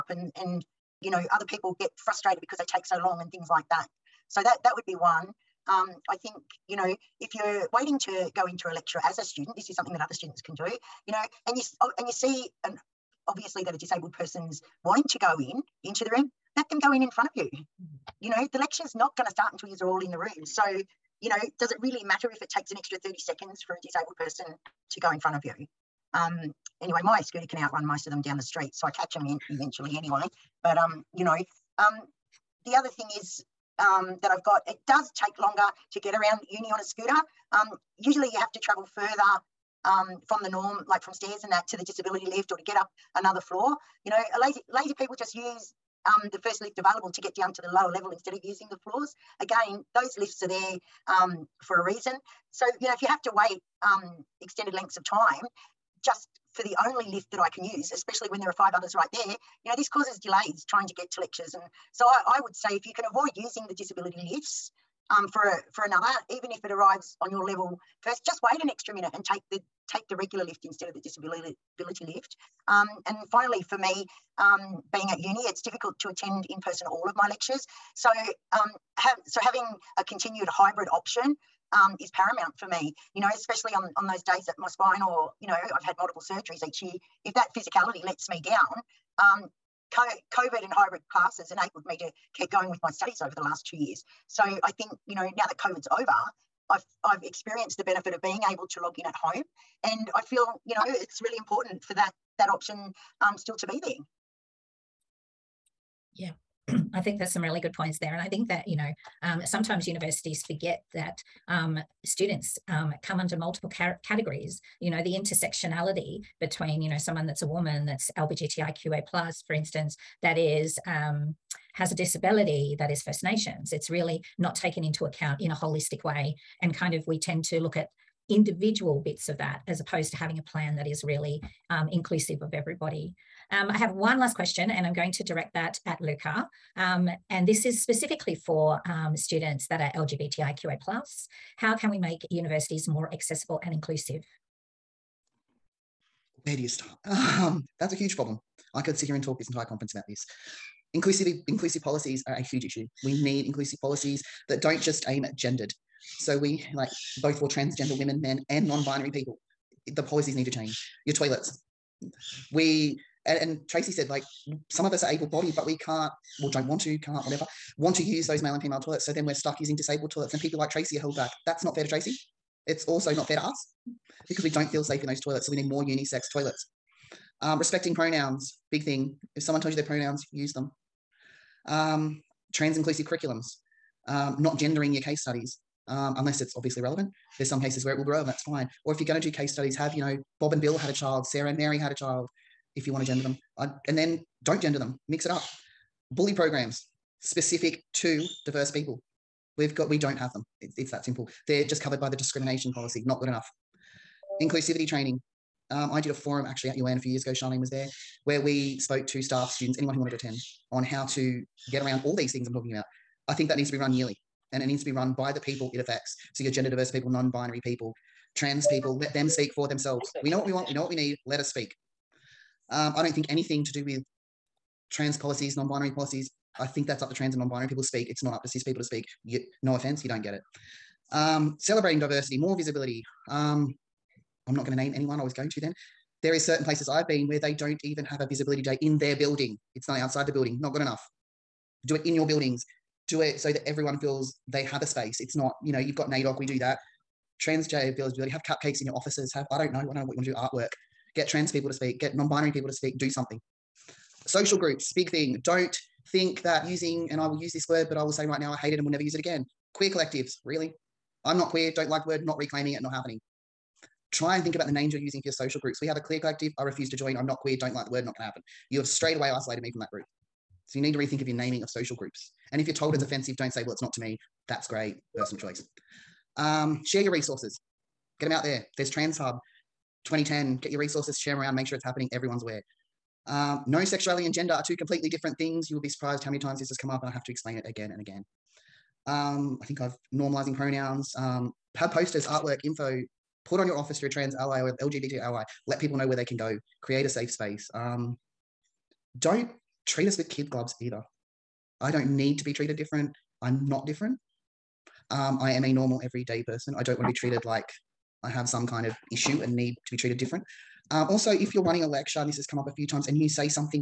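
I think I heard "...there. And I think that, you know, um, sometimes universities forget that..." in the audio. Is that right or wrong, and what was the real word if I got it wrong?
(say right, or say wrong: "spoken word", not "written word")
right.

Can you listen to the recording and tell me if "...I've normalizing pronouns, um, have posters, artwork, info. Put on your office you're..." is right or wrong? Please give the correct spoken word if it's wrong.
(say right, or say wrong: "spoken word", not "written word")
right.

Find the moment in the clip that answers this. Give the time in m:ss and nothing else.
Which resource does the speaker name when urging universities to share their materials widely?
4:38.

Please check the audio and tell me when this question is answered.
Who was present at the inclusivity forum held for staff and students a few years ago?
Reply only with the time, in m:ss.
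3:27.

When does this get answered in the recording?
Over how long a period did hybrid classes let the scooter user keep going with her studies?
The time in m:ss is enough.
1:33.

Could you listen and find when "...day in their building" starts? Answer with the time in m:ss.
3:58.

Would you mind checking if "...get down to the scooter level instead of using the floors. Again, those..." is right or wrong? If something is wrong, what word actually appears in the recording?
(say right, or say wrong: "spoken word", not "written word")
wrong: "lower", not "scooter".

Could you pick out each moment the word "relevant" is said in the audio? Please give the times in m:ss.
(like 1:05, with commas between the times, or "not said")
3:06.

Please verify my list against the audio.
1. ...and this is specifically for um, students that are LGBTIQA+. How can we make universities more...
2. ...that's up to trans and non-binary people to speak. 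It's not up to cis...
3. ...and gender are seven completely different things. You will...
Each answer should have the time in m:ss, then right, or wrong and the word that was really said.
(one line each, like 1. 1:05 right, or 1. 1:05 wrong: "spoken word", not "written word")
1. 2:17 right
2. 3:46 right
3. 4:44 wrong: "two", not "seven".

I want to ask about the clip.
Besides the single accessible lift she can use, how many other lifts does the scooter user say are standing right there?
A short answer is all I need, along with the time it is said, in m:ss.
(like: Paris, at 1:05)
5, at 0:58.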